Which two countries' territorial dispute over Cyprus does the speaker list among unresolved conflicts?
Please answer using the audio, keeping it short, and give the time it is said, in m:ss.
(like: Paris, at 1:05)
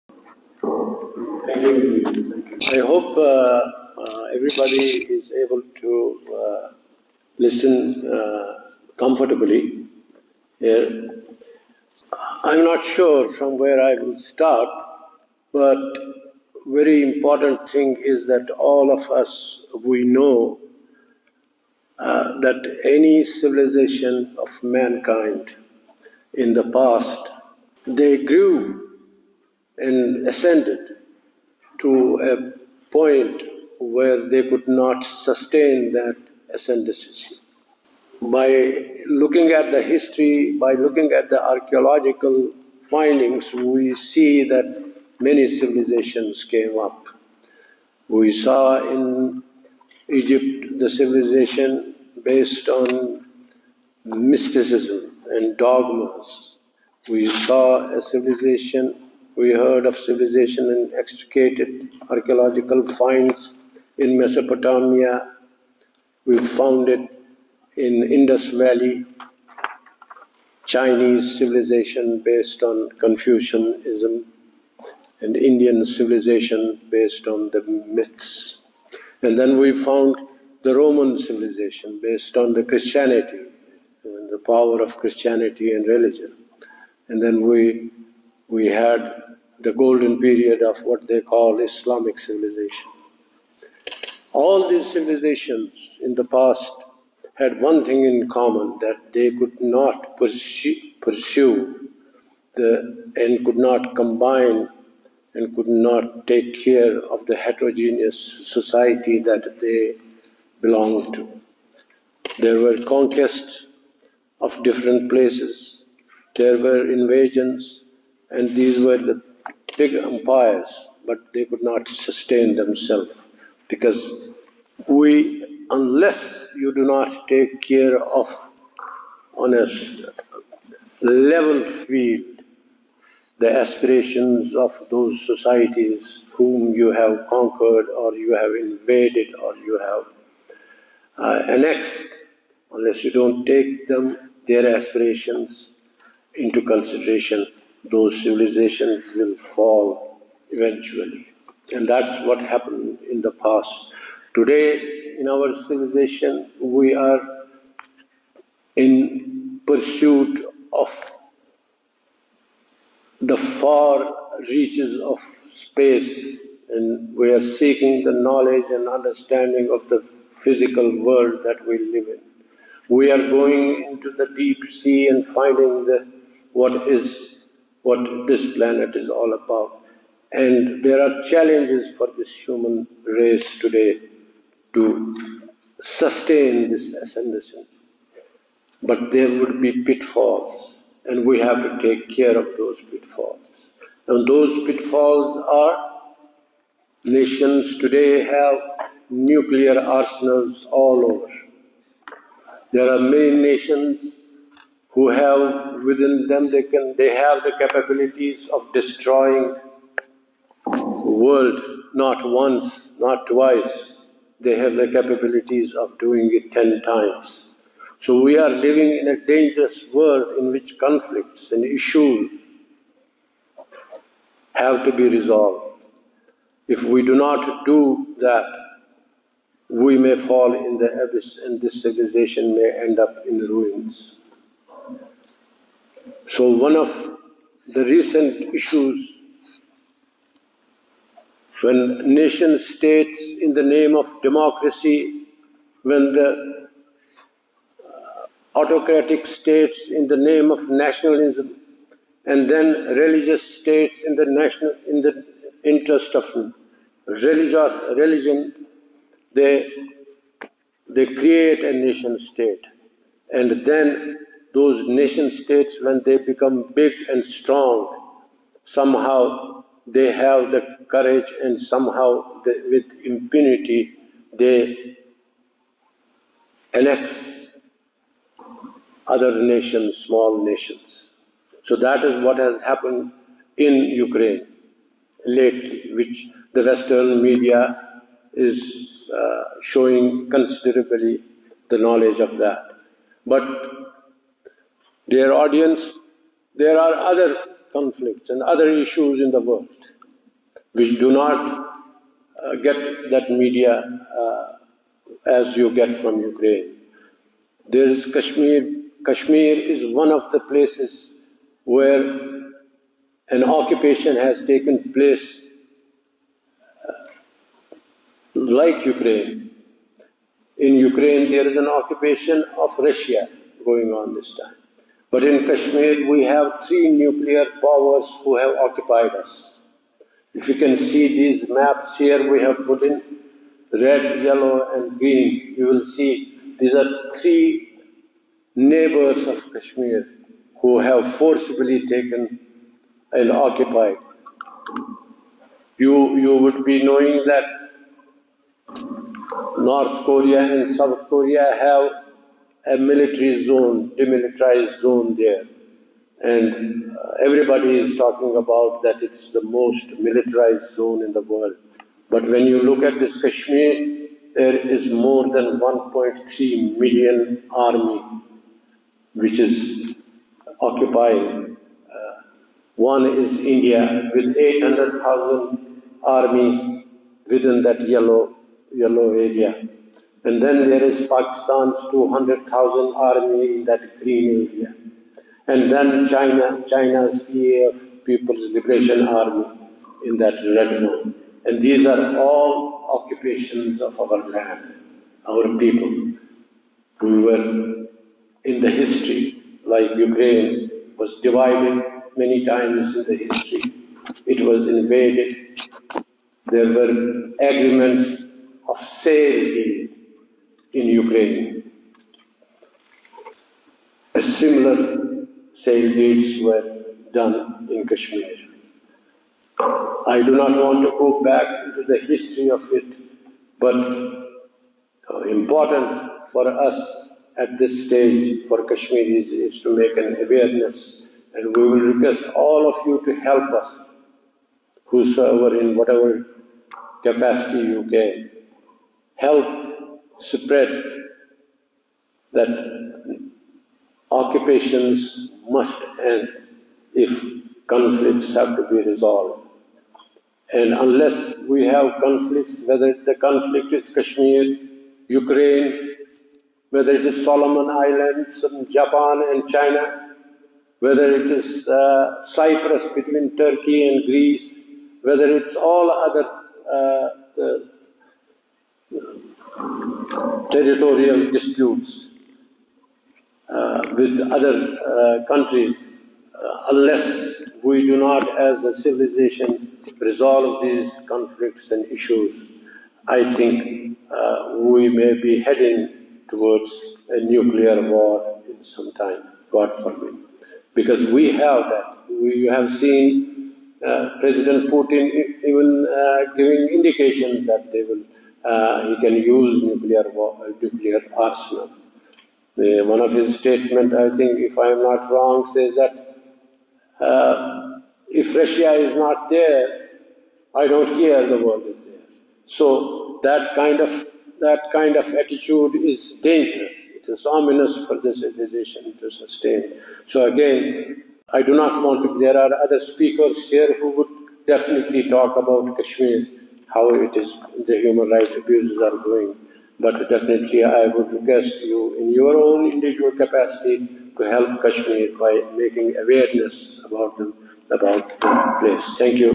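Turkey and Greece, at 7:43.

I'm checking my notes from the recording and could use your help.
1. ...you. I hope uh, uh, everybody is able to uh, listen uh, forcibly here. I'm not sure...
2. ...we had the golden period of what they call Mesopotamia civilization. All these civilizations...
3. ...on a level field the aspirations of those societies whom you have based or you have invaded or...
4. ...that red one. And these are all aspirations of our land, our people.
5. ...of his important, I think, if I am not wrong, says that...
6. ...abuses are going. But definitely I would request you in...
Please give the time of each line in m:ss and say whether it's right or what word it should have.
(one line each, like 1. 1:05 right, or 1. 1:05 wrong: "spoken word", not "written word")
1. 0:01 wrong: "comfortably", not "forcibly"
2. 1:28 wrong: "Islamic", not "Mesopotamia"
3. 2:09 wrong: "conquered", not "based"
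4. 6:30 wrong: "occupations", not "aspirations"
5. 8:22 wrong: "statement", not "important"
6. 8:48 right.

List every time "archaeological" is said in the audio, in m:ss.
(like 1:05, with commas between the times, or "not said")
0:41, 1:02.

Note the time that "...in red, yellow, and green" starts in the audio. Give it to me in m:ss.
5:32.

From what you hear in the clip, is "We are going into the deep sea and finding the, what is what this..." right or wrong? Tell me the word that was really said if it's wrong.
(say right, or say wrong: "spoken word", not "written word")
right.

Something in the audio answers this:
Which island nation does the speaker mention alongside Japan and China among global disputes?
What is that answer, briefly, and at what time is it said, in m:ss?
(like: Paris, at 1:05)
Solomon Islands, at 7:37.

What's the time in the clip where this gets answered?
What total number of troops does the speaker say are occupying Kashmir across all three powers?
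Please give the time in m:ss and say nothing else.
6:05.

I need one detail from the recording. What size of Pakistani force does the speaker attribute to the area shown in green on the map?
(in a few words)
200,000.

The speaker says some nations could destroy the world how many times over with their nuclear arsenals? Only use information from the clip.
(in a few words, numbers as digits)
10 times.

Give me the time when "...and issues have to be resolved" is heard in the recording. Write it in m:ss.
3:41.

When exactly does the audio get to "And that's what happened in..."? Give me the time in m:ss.
2:31.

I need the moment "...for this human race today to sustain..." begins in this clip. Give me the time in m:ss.
3:01.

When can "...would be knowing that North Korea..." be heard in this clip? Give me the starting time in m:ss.
5:46.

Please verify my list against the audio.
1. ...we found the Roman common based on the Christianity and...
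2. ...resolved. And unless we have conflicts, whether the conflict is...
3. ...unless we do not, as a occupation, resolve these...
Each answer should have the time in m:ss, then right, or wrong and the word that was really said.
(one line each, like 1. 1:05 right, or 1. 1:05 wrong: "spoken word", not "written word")
1. 1:19 wrong: "civilization", not "common"
2. 7:28 right
3. 7:56 wrong: "civilization", not "occupation".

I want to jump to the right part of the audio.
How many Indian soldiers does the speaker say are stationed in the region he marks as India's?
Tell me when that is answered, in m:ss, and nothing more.
6:14.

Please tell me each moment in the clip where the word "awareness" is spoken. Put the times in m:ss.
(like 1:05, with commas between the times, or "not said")
7:10, 8:56.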